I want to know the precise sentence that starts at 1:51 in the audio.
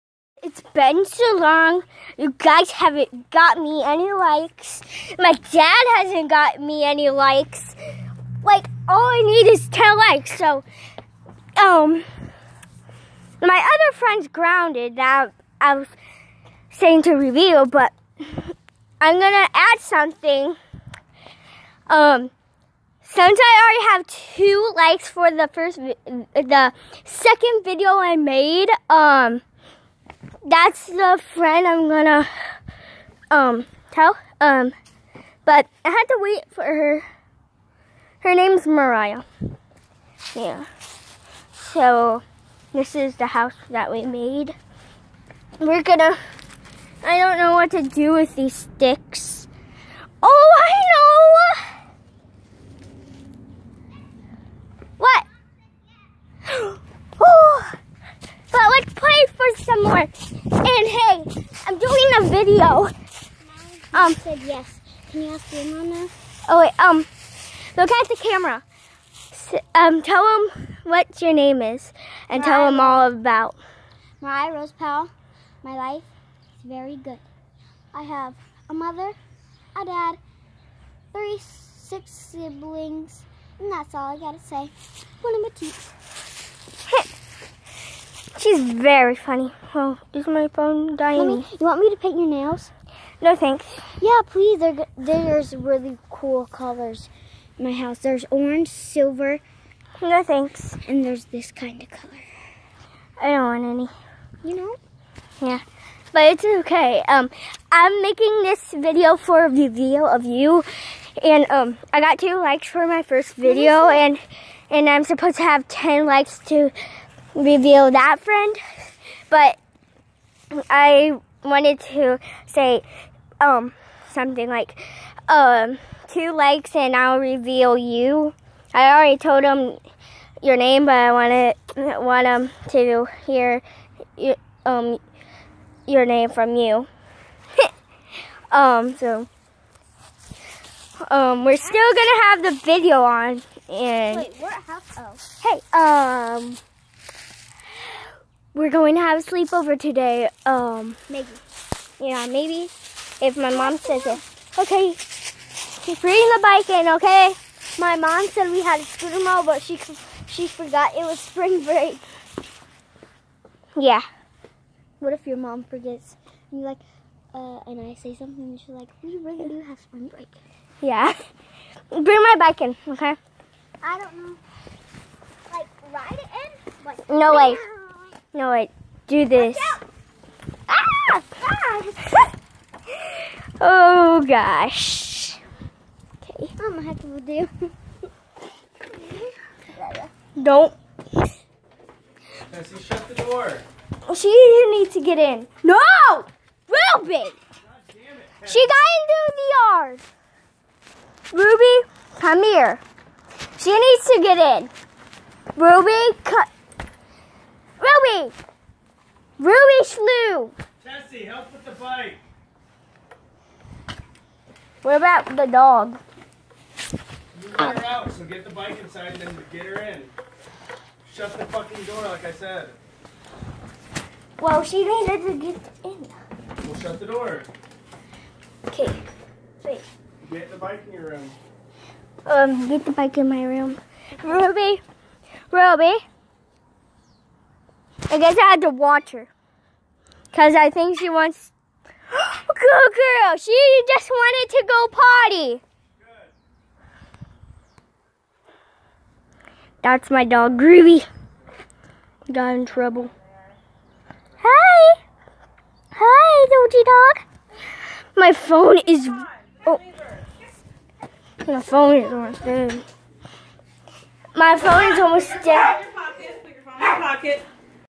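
And um, I got two likes for my first video.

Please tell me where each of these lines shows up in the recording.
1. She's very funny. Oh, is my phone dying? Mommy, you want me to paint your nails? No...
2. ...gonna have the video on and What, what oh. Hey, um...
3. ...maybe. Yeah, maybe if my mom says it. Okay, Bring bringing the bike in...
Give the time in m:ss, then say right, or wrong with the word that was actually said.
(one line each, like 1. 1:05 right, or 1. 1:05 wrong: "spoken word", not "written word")
1. 1:28 right
2. 2:21 wrong: "Wait", not "What"
3. 2:31 right.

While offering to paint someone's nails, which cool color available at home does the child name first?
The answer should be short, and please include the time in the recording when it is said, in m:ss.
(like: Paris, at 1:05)
Orange, at 1:38.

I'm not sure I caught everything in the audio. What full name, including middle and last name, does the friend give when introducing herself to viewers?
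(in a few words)
Mariah Rose Powell.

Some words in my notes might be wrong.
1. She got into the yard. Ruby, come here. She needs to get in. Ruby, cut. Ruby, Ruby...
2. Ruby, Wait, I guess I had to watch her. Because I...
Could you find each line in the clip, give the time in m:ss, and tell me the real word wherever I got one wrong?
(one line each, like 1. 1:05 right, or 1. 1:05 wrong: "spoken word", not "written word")
1. 3:18 right
2. 3:54 wrong: "Ruby", not "Wait".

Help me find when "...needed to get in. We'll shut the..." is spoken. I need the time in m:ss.
3:44.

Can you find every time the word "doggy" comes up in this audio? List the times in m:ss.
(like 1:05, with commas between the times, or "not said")
4:16.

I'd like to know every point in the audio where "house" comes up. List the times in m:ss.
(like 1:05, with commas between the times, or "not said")
0:43, 1:37.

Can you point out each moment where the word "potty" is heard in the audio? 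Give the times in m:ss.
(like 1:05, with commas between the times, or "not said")
4:04.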